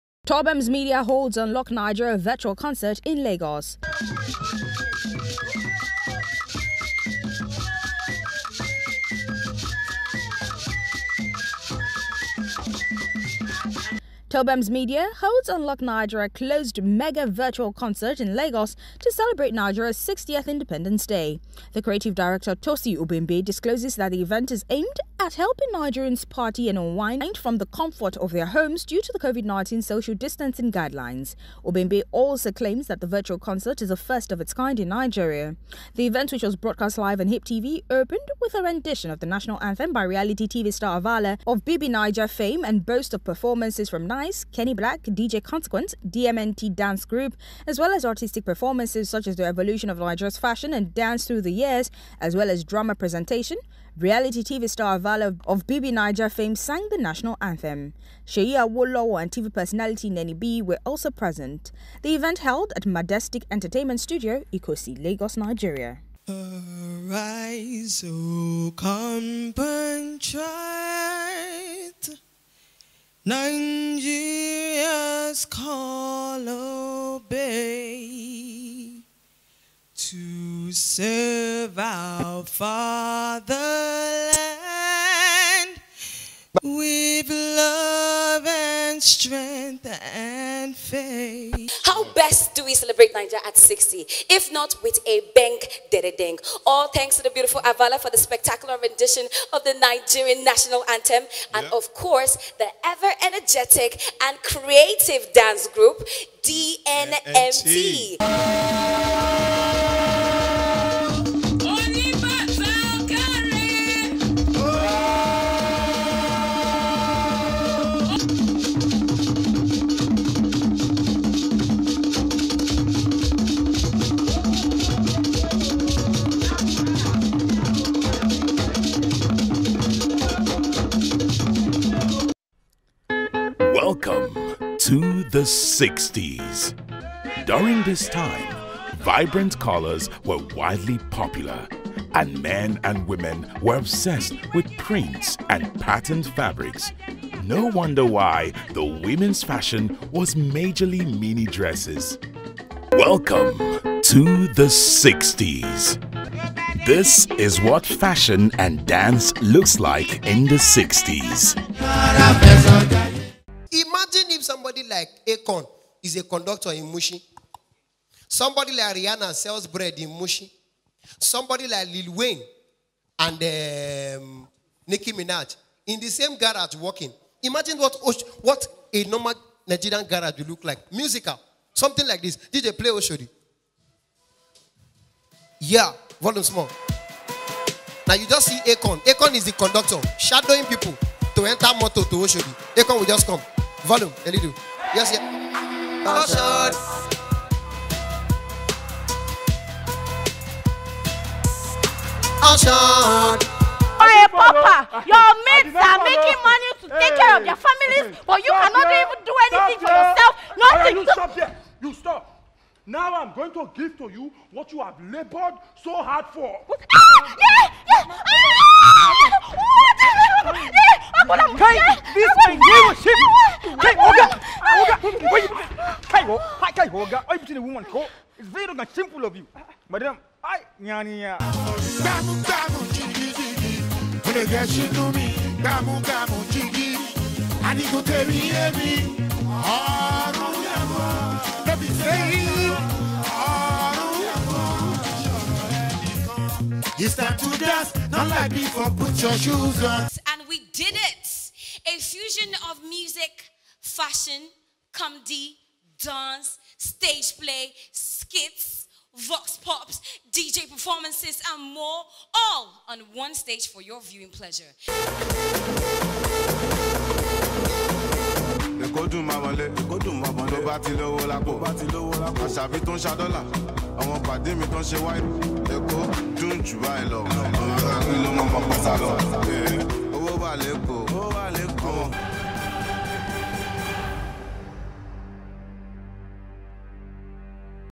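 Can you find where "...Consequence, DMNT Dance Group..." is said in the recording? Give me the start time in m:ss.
0:45.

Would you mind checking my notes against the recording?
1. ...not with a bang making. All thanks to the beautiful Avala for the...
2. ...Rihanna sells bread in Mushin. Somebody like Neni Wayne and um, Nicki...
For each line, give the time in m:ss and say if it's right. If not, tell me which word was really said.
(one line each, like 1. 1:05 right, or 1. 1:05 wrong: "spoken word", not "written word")
1. 1:34 wrong: "dededeng", not "making"
2. 2:48 wrong: "Lil", not "Neni".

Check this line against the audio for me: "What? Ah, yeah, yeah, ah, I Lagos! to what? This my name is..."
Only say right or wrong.
wrong.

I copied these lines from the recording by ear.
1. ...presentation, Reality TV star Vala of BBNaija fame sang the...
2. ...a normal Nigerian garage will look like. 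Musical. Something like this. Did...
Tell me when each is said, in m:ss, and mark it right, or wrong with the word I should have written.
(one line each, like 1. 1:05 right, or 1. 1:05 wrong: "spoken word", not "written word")
1. 0:52 right
2. 2:58 right.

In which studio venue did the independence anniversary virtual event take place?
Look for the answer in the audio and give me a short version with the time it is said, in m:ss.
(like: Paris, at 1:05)
Majestic Entertainment Studio, at 1:02.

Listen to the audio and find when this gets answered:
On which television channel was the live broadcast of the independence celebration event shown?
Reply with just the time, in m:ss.
0:37.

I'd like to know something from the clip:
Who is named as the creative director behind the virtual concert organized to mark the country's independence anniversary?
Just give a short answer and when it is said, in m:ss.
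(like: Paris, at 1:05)
Tosi Obembe, at 0:22.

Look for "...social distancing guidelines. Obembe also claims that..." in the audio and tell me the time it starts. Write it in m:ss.
0:29.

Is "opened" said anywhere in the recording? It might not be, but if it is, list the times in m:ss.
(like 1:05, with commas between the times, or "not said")
0:37.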